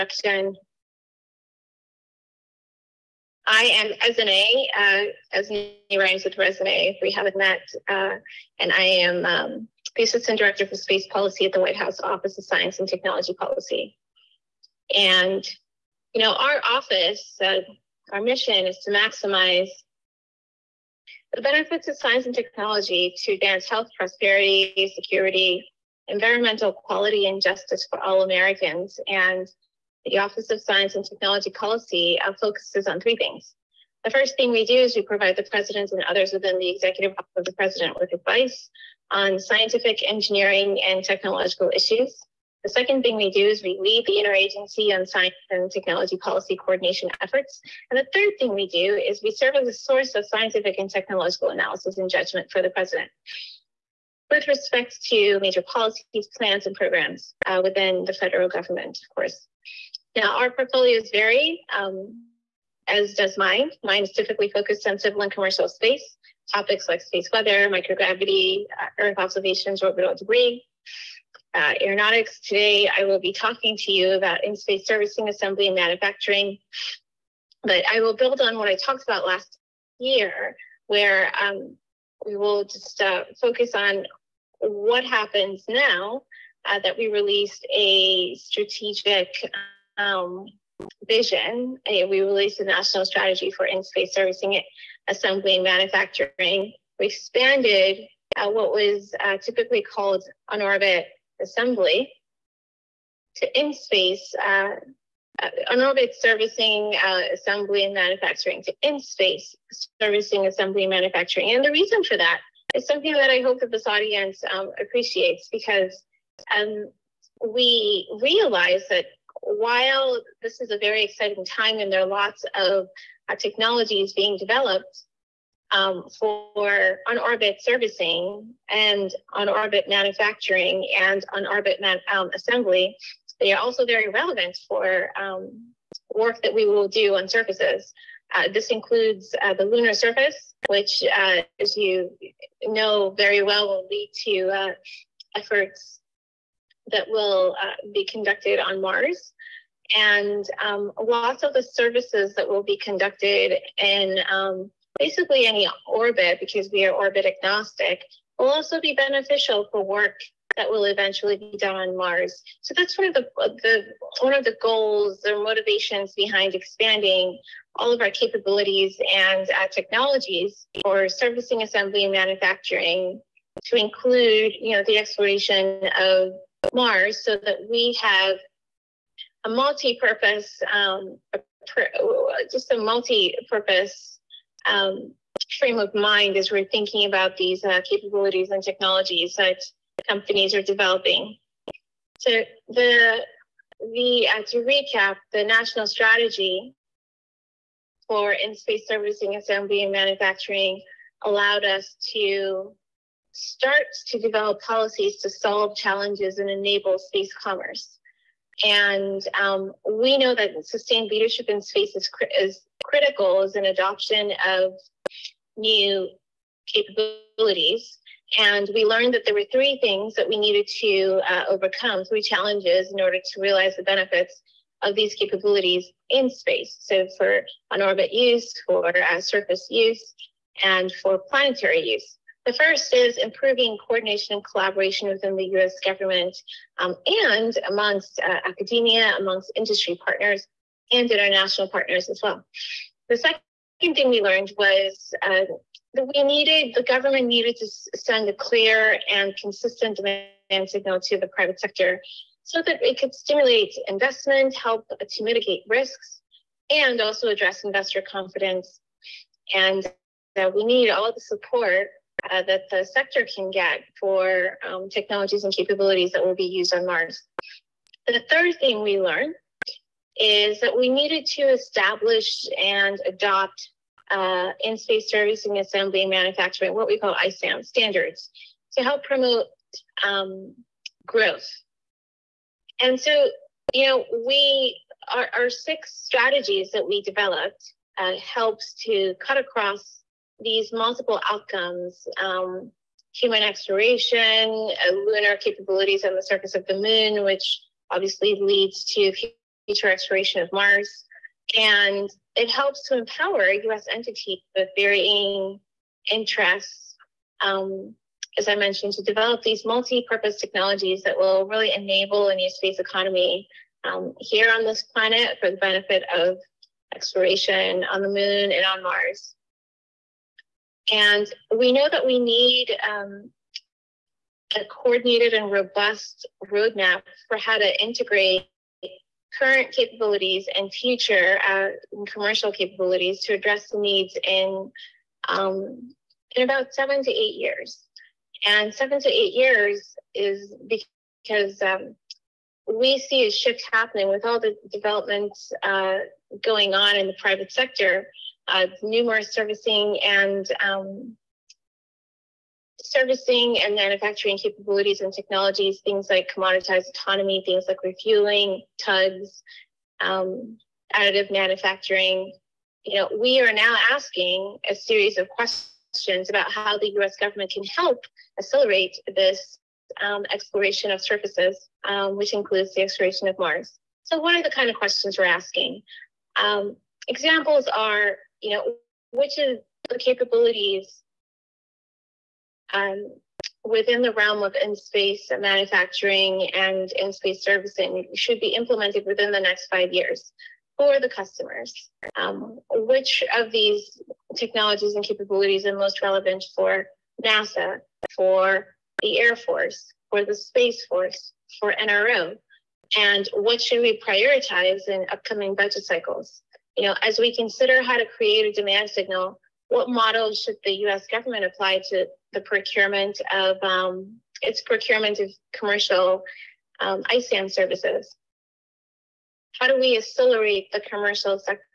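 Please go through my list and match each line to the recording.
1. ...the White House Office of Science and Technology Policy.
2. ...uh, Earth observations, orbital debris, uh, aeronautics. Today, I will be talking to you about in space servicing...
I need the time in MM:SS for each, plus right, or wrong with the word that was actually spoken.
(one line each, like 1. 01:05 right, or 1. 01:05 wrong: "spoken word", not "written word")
1. 00:11 right
2. 01:08 right.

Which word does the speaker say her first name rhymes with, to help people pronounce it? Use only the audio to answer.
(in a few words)
resume.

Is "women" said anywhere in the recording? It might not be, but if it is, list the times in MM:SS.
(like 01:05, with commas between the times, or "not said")
not said.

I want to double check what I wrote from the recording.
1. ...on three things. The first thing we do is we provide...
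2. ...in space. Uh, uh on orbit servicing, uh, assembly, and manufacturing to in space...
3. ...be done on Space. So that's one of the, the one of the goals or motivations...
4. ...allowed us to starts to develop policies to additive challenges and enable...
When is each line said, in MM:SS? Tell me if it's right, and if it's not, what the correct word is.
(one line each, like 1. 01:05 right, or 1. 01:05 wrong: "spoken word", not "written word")
1. 00:32 right
2. 01:43 right
3. 02:41 wrong: "Mars", not "Space"
4. 03:21 wrong: "solve", not "additive".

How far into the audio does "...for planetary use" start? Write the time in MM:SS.
03:51.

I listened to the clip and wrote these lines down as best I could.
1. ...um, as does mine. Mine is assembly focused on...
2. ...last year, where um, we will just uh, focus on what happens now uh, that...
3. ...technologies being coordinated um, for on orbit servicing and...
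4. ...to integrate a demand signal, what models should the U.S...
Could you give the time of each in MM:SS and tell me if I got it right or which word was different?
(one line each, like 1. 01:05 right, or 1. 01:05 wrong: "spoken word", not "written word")
1. 01:01 wrong: "typically", not "assembly"
2. 01:19 right
3. 02:03 wrong: "developed", not "coordinated"
4. 06:47 wrong: "create", not "integrate".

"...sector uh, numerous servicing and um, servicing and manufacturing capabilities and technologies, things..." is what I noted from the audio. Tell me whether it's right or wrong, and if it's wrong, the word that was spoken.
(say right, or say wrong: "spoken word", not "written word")
right.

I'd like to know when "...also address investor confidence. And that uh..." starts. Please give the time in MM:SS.
04:17.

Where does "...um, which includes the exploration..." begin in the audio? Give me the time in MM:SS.
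06:11.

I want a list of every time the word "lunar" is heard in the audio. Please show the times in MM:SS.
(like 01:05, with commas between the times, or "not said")
02:19, 04:54.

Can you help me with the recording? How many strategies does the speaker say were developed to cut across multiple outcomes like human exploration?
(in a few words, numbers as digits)
6.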